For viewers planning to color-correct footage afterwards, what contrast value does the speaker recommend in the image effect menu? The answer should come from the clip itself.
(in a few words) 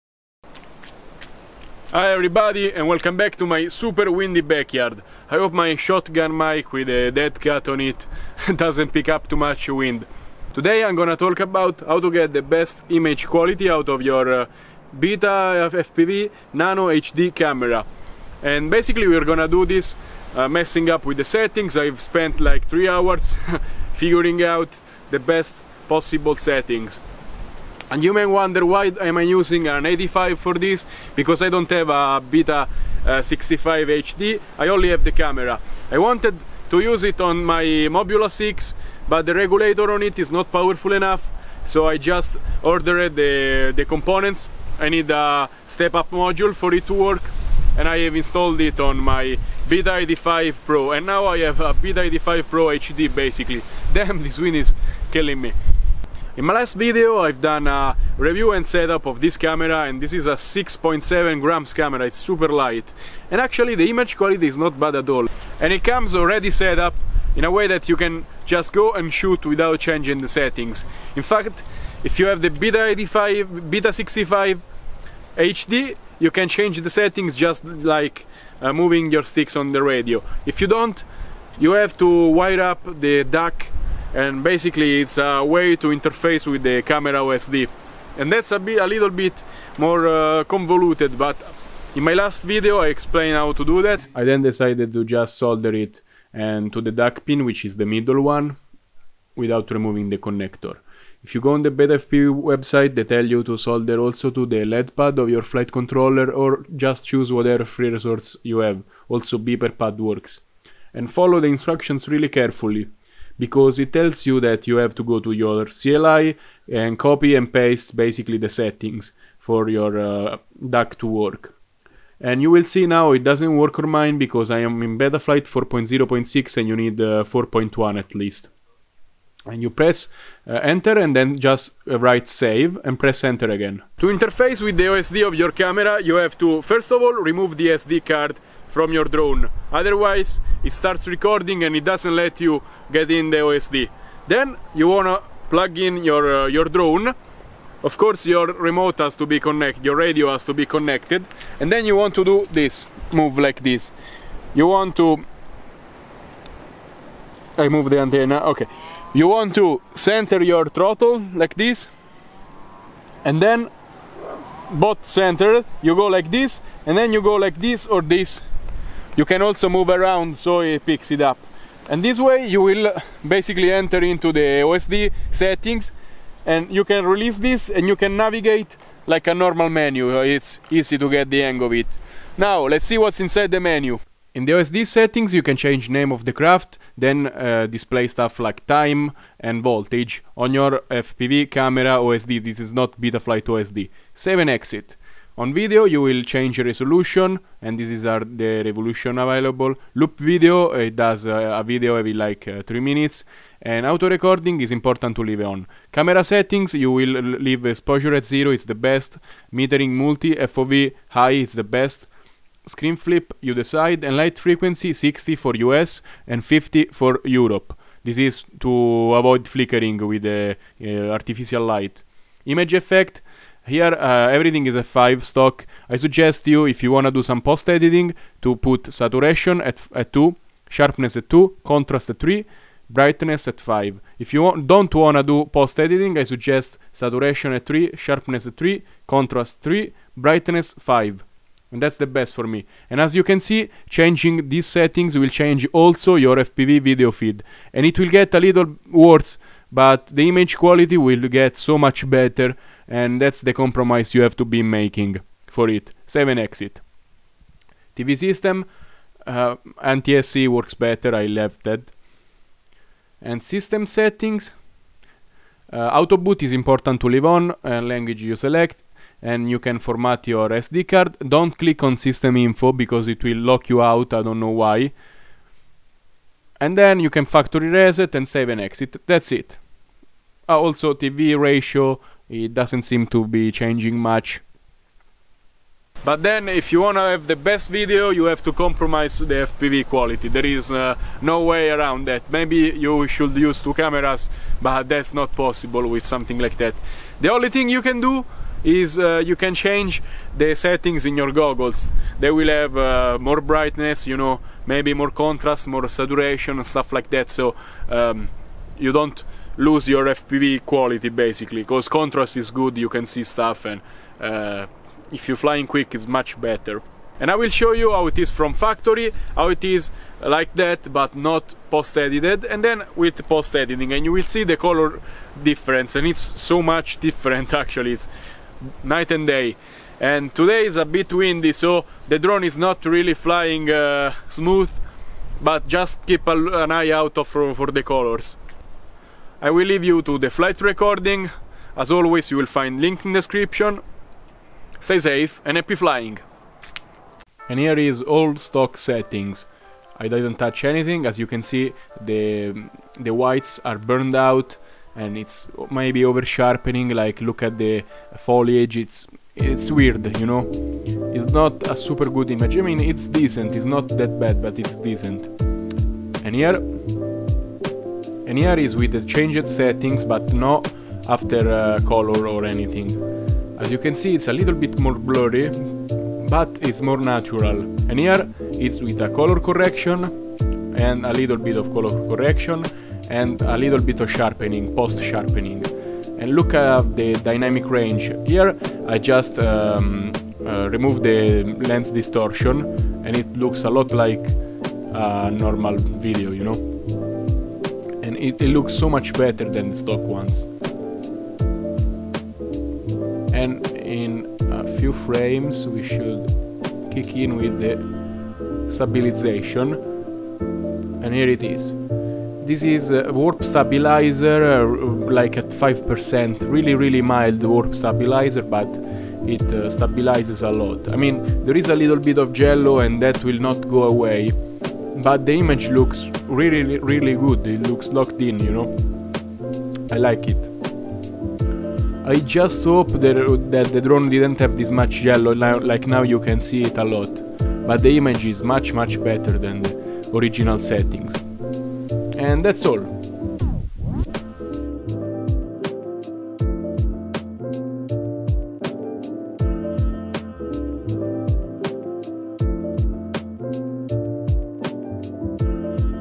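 3.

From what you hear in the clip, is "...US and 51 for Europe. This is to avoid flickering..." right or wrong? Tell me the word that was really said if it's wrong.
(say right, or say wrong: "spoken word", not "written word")
wrong: "50", not "51".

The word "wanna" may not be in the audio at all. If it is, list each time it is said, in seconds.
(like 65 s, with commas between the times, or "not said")
144 s, 286 s.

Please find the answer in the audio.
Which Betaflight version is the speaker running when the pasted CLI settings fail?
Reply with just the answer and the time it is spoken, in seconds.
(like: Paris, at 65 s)
4.0.6, at 125 s.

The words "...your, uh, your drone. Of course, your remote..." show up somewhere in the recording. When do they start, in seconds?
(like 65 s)
146 s.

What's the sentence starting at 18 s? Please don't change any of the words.
And basically we're gonna do this uh, messing up with the settings.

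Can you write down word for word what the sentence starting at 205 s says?
Camera settings, you will leave exposure at 0, it's the best.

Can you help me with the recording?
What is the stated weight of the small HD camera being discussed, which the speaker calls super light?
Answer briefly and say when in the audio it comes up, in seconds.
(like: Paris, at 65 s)
6.7 grams, at 60 s.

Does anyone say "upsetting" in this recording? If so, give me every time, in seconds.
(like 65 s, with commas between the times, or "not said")
not said.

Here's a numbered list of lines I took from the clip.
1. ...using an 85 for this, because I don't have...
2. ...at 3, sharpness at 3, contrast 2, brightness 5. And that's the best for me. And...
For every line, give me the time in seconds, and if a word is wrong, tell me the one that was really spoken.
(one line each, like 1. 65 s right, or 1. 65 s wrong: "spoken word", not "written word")
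1. 29 s right
2. 237 s wrong: "3", not "2".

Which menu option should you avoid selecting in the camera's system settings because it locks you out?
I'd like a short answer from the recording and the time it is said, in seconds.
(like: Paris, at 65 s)
system info, at 271 s.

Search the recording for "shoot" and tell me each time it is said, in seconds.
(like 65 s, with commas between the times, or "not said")
69 s.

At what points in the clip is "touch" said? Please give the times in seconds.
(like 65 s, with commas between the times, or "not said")
350 s.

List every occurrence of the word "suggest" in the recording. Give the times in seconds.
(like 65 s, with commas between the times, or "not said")
225 s, 236 s.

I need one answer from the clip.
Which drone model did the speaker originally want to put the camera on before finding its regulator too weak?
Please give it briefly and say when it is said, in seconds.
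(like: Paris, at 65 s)
Mobula 6, at 37 s.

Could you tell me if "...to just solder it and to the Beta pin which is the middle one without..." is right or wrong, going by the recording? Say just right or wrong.
wrong.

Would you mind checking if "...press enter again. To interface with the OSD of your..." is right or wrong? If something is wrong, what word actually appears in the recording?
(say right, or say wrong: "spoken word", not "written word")
right.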